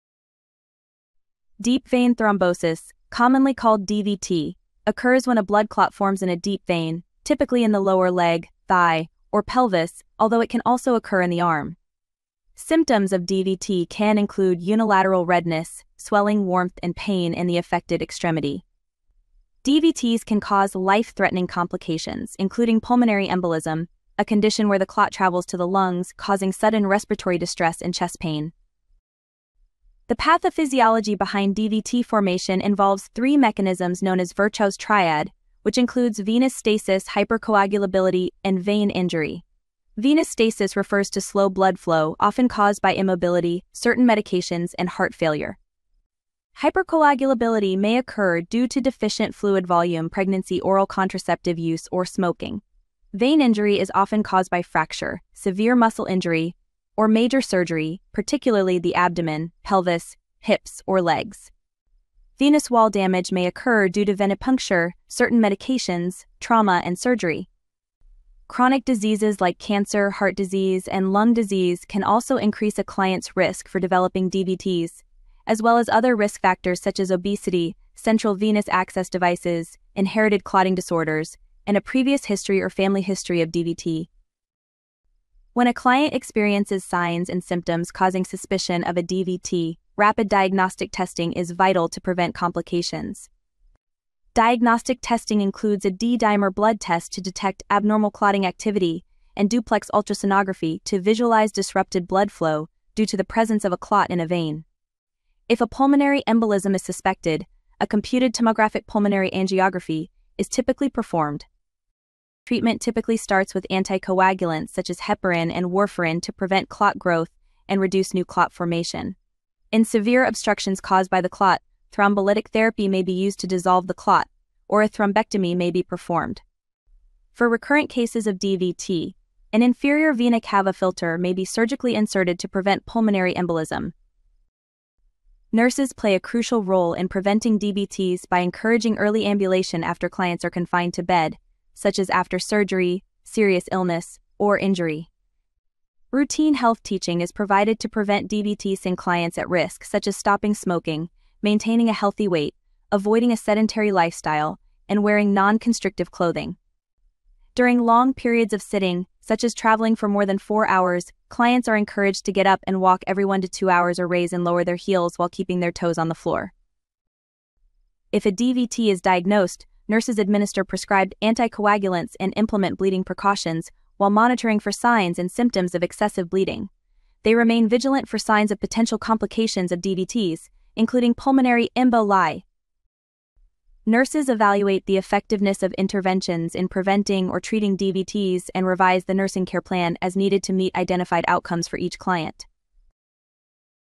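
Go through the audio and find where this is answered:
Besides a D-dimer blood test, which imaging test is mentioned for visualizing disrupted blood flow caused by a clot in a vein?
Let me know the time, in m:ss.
1:39.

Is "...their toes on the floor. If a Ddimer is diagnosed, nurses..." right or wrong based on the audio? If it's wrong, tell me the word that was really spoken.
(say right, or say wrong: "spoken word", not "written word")
wrong: "DVT", not "Ddimer".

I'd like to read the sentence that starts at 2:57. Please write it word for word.
They remain vigilant for signs of potential complications of DVTs, including pulmonary emboli.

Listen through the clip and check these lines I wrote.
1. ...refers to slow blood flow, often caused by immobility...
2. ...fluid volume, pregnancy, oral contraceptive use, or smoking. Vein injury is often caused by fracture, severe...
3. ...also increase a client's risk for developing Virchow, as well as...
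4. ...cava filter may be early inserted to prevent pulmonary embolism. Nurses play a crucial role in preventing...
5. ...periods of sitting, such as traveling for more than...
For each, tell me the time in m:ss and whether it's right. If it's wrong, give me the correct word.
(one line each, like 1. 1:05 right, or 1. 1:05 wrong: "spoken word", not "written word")
1. 0:40 right
2. 0:49 right
3. 1:12 wrong: "DVTs", not "Virchow"
4. 2:10 wrong: "surgically", not "early"
5. 2:38 right.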